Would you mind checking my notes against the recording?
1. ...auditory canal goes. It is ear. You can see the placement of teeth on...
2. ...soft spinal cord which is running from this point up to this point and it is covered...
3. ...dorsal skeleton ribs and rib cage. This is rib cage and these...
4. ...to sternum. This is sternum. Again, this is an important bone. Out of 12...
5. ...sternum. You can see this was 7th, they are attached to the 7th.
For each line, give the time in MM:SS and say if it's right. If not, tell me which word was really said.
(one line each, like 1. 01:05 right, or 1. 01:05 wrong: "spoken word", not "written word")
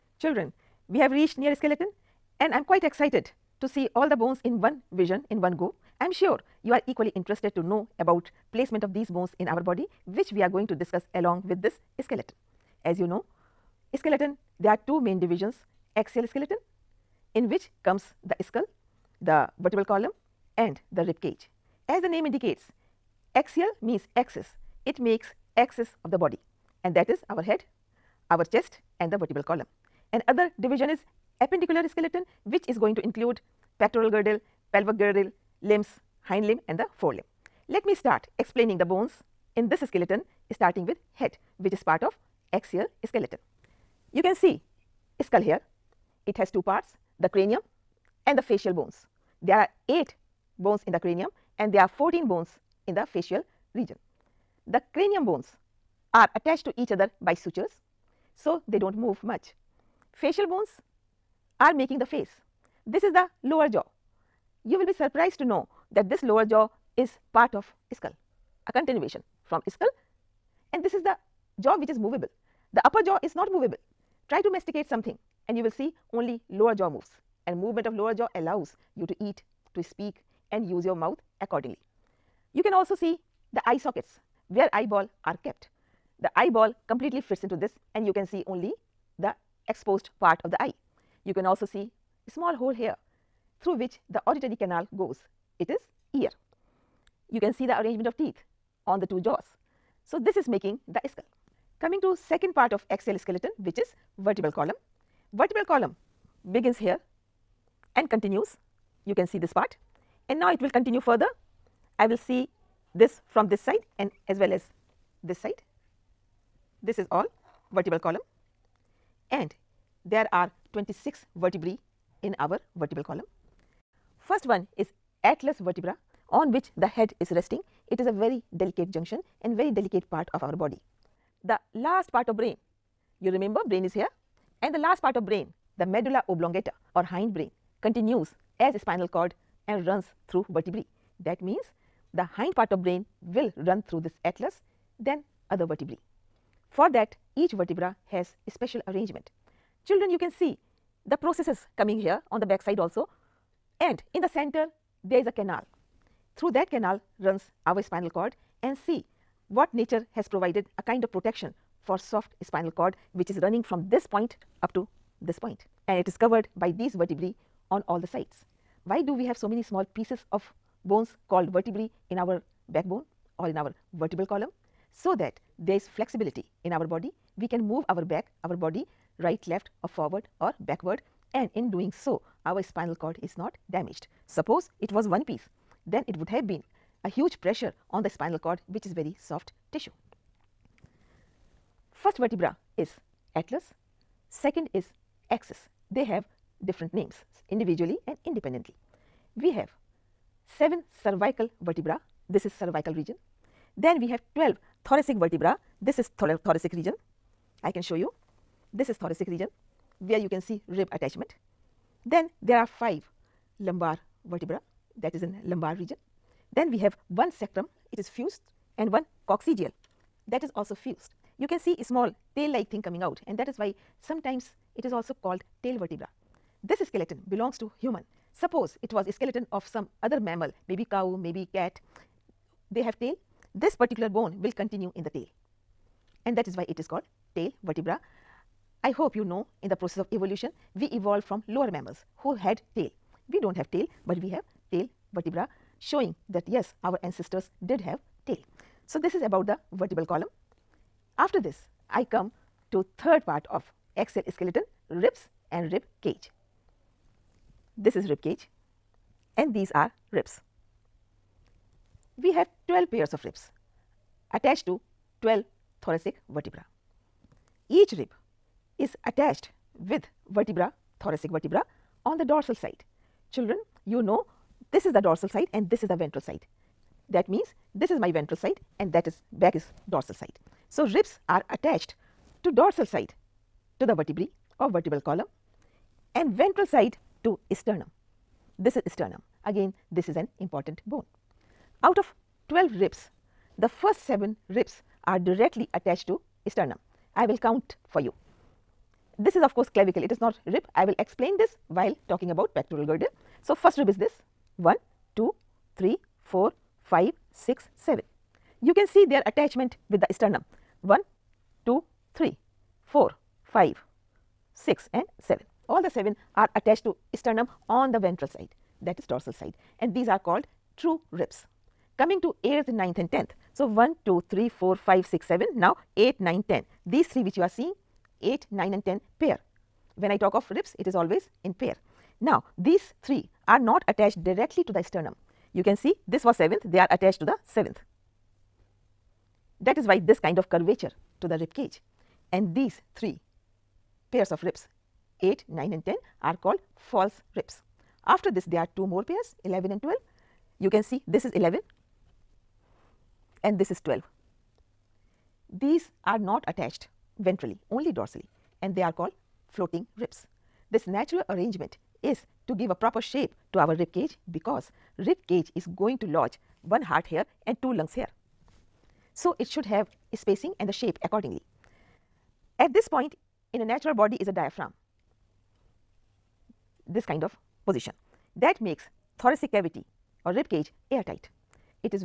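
1. 01:34 wrong: "arrangement", not "placement"
2. 02:42 right
3. 04:13 wrong: "axial", not "dorsal"
4. 04:47 right
5. 05:34 right.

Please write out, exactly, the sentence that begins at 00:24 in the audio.
It makes axis of the body and that is our head, our chest and the vertebral column.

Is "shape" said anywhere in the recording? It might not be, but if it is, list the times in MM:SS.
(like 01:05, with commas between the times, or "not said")
06:02, 06:10.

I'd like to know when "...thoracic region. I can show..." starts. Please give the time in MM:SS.
03:26.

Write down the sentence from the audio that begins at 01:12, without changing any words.
The upper jaw is not movable.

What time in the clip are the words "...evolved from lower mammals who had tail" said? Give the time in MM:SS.
04:00.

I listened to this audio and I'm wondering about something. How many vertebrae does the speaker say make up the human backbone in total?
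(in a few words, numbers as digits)
26.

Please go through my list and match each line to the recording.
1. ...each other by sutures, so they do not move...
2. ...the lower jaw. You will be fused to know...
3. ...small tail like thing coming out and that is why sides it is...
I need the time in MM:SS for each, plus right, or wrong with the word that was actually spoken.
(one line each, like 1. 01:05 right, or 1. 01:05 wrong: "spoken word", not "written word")
1. 00:56 right
2. 01:03 wrong: "surprised", not "fused"
3. 03:41 wrong: "sometimes", not "sides".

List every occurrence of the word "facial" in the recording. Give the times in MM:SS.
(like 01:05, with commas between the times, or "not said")
00:48, 00:53, 01:00.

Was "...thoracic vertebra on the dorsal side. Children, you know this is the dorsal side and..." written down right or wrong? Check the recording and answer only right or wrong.
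right.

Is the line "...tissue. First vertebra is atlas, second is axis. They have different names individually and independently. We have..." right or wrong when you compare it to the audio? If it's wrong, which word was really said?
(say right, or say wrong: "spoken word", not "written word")
right.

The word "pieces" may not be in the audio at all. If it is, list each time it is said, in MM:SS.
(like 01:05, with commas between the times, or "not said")
02:49, 03:05.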